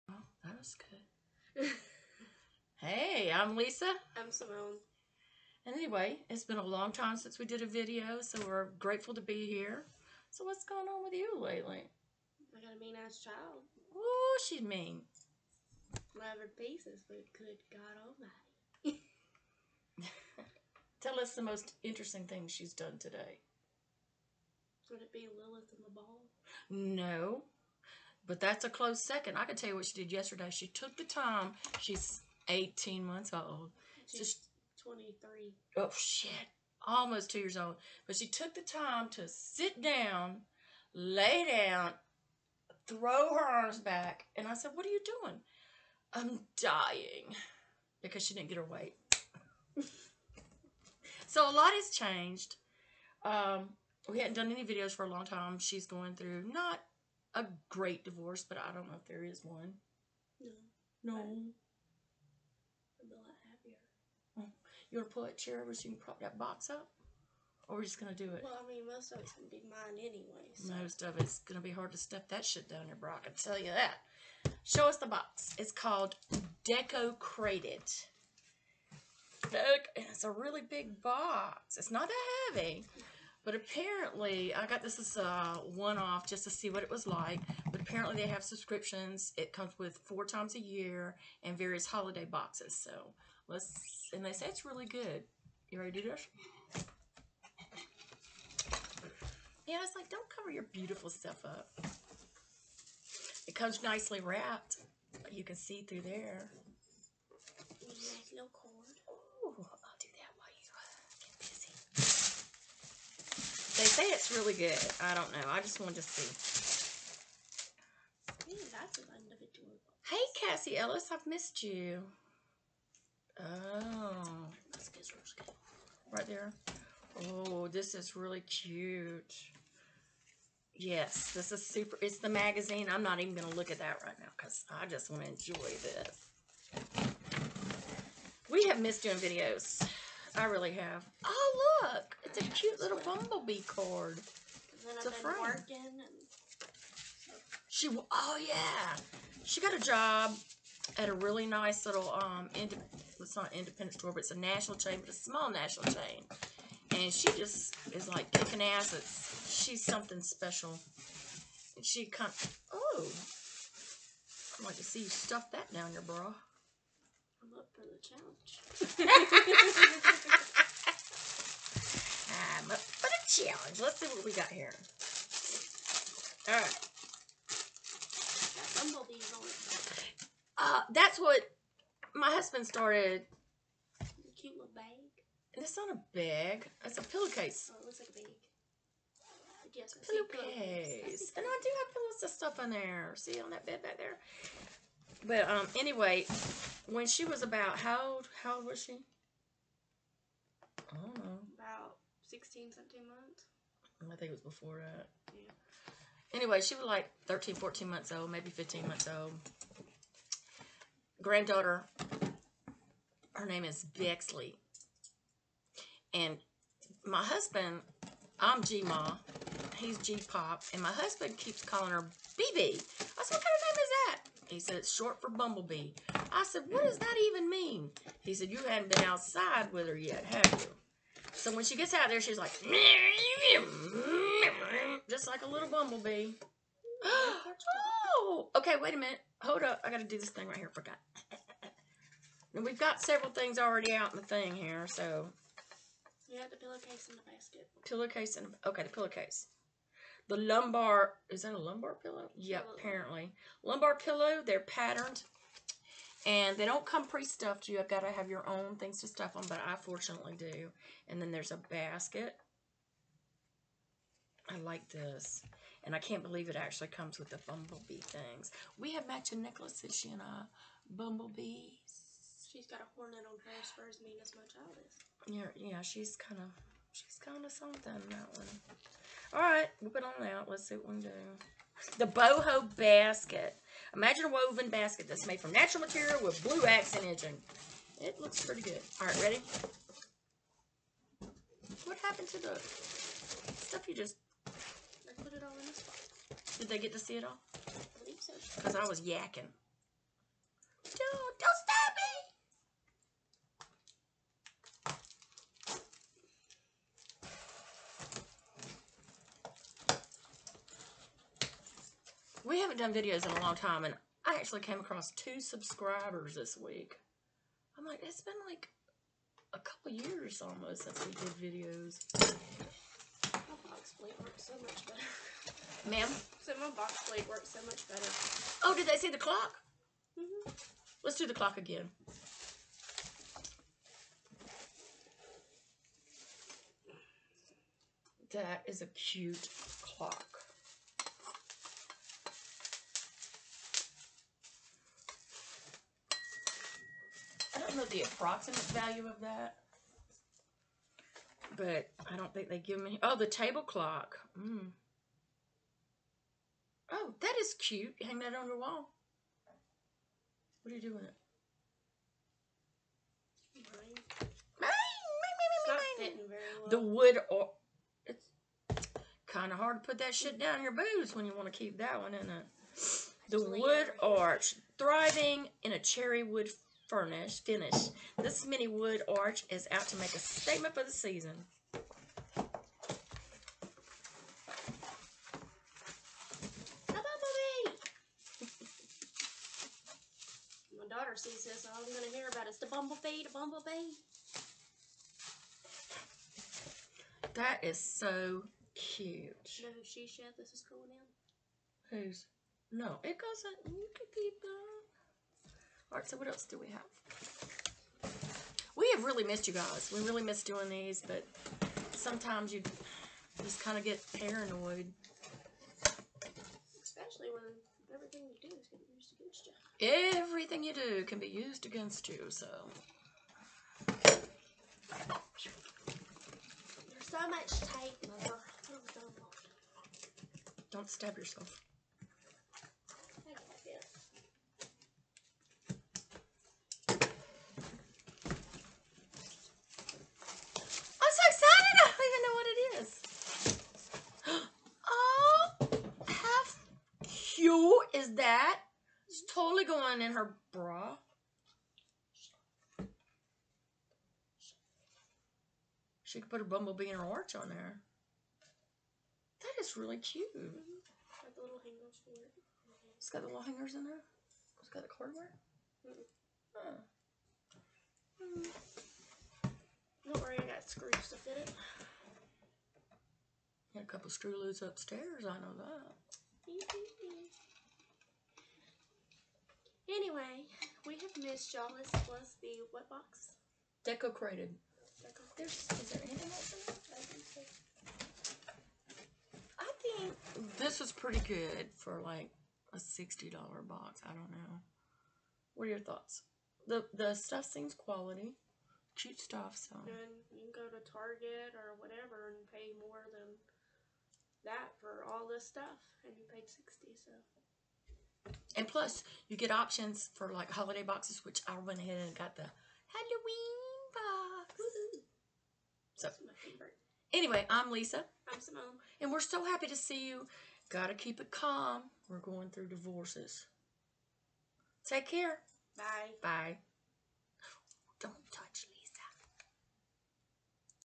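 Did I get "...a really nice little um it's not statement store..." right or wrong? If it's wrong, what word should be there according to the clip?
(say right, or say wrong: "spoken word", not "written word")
wrong: "independent", not "statement".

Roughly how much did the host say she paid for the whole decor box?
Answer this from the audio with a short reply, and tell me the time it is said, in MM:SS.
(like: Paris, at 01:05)
$60, at 08:12.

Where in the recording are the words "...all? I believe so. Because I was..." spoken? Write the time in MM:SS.
04:57.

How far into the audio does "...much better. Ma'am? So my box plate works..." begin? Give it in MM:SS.
05:24.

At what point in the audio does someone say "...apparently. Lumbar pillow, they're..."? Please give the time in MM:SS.
04:12.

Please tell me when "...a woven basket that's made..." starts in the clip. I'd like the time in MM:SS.
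04:44.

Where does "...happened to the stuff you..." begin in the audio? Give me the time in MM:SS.
04:51.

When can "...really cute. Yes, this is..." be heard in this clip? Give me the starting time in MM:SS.
02:08.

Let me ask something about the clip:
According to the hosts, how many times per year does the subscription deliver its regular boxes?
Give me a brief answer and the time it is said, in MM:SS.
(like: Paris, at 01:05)
four, at 01:29.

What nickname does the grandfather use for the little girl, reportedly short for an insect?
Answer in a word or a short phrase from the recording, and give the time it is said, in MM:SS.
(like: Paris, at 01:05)
BB, at 03:41.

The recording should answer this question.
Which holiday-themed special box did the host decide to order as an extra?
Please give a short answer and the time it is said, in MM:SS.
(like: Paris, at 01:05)
Halloween, at 08:32.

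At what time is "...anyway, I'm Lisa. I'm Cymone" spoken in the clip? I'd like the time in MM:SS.
08:37.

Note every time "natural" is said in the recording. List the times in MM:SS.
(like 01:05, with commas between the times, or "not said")
04:45.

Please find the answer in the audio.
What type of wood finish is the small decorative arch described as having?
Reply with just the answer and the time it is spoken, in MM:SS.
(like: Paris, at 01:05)
cherry wood, at 06:15.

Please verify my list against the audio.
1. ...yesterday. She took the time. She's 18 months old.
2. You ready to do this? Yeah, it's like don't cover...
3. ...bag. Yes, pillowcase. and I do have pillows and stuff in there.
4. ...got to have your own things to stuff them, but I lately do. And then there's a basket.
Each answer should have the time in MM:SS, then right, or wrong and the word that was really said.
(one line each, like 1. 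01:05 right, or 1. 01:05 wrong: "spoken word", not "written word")
1. 00:30 right
2. 01:35 right
3. 03:08 right
4. 04:17 wrong: "fortunately", not "lately".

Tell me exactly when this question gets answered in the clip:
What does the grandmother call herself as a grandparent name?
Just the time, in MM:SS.
03:38.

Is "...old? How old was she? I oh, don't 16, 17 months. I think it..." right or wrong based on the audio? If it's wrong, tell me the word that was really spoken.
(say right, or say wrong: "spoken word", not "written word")
right.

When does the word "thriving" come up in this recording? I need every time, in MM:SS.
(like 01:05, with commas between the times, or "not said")
06:14.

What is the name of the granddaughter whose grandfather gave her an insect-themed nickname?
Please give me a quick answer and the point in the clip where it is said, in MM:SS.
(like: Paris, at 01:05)
Bexley, at 03:33.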